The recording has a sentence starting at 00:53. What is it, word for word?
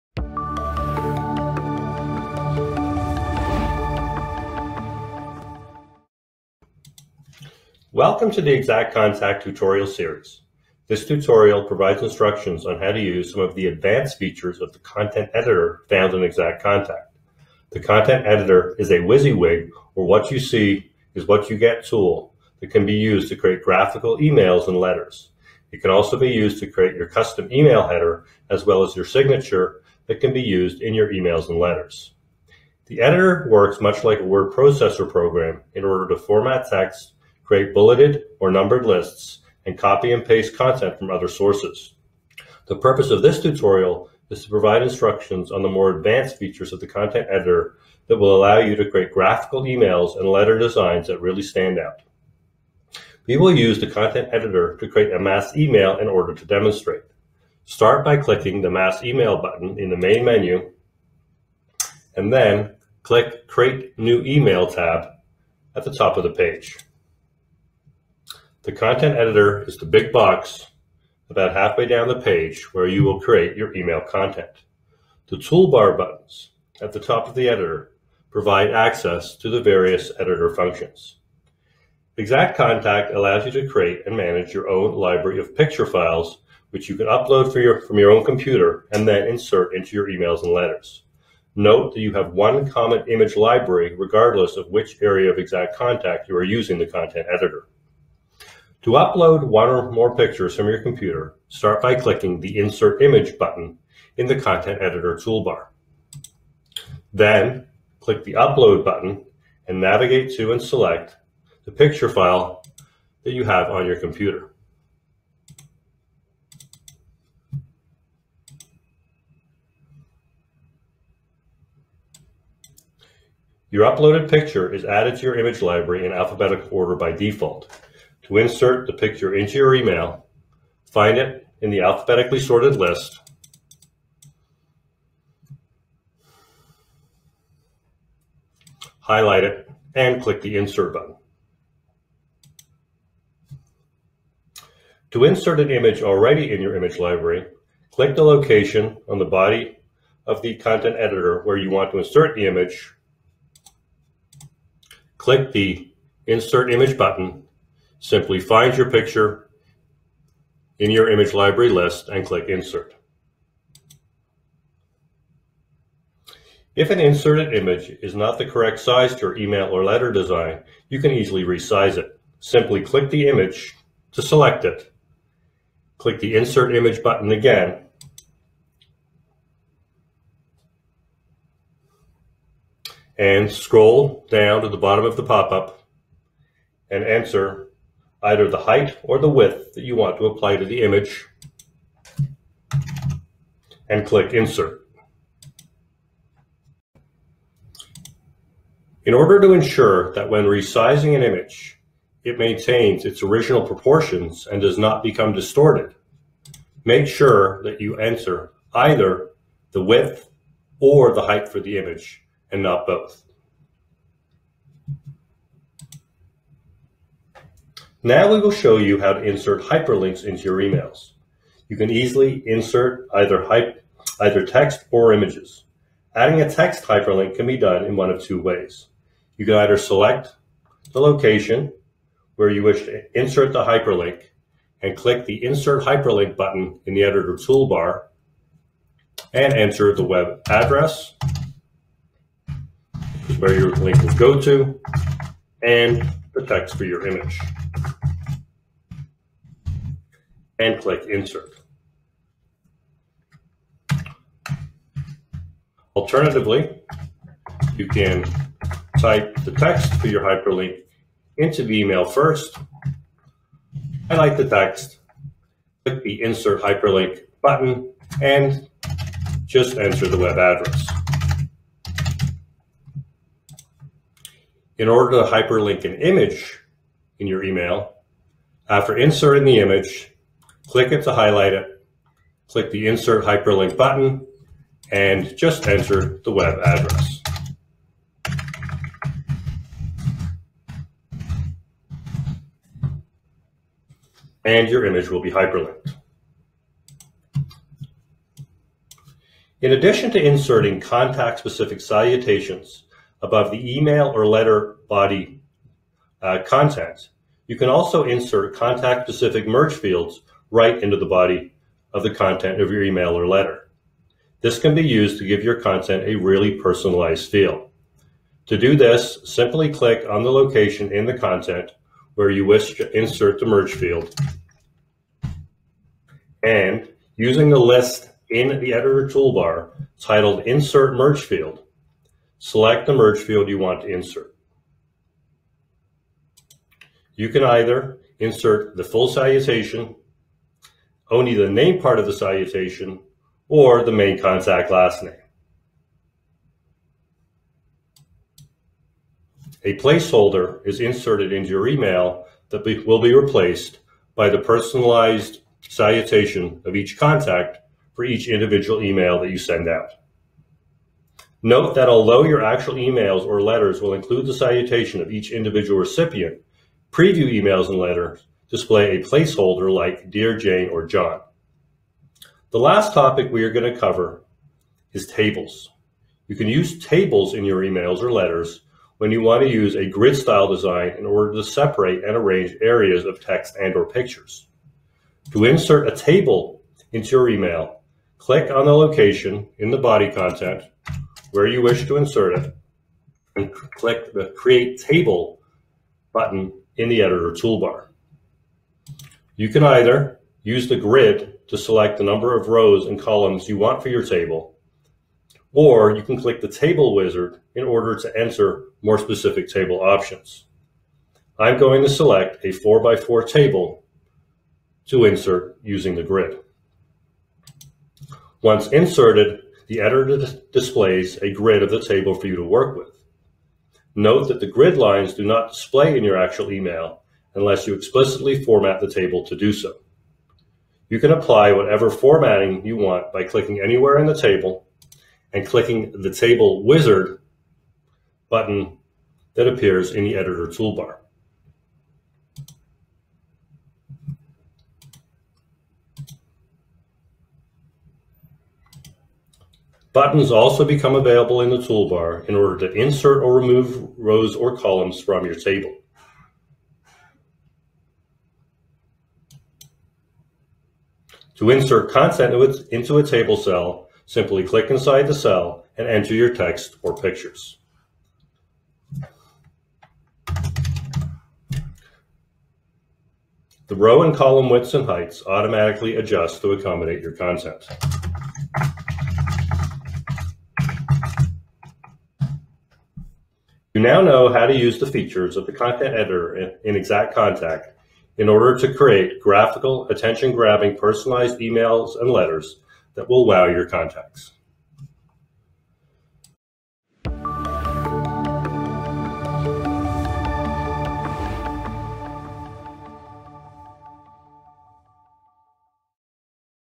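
We will use the content editor to create a mass email in order to demonstrate.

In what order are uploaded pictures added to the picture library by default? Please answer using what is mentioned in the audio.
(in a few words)
alphabetical order.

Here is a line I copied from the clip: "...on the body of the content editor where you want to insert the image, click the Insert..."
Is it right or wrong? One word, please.
right.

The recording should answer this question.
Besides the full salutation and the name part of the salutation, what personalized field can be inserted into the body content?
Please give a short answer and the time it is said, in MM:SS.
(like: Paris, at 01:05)
main contact last name, at 05:43.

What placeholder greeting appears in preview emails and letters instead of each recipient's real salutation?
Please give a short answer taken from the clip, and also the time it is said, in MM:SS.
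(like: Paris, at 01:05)
Dear Jane or John, at 06:10.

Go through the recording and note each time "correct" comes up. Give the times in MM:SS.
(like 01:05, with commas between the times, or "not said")
02:48.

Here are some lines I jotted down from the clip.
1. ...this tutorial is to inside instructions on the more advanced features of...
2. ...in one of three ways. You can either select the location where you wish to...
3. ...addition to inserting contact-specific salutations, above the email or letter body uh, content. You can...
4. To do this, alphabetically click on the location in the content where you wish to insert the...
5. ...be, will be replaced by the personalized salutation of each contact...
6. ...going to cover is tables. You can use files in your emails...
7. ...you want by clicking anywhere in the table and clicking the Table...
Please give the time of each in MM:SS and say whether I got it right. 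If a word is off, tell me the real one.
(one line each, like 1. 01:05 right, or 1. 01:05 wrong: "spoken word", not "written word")
1. 00:43 wrong: "provide", not "inside"
2. 03:47 wrong: "two", not "three"
3. 04:59 right
4. 05:18 wrong: "simply", not "alphabetically"
5. 05:52 right
6. 06:13 wrong: "tables", not "files"
7. 07:12 right.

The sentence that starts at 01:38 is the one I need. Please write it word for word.
To upload one or more pictures from your computer, start by clicking the Insert Image button in the Content Editor toolbar.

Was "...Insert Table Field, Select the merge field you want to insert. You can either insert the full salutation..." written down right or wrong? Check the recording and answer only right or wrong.
wrong.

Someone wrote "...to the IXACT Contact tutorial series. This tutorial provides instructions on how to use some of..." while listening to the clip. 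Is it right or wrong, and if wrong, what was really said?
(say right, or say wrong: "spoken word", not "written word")
right.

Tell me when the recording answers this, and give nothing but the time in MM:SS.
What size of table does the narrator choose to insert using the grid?
06:52.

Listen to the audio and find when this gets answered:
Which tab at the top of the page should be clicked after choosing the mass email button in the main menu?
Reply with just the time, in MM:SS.
01:03.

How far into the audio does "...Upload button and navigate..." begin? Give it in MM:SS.
01:48.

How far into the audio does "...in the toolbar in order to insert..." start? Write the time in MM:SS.
07:31.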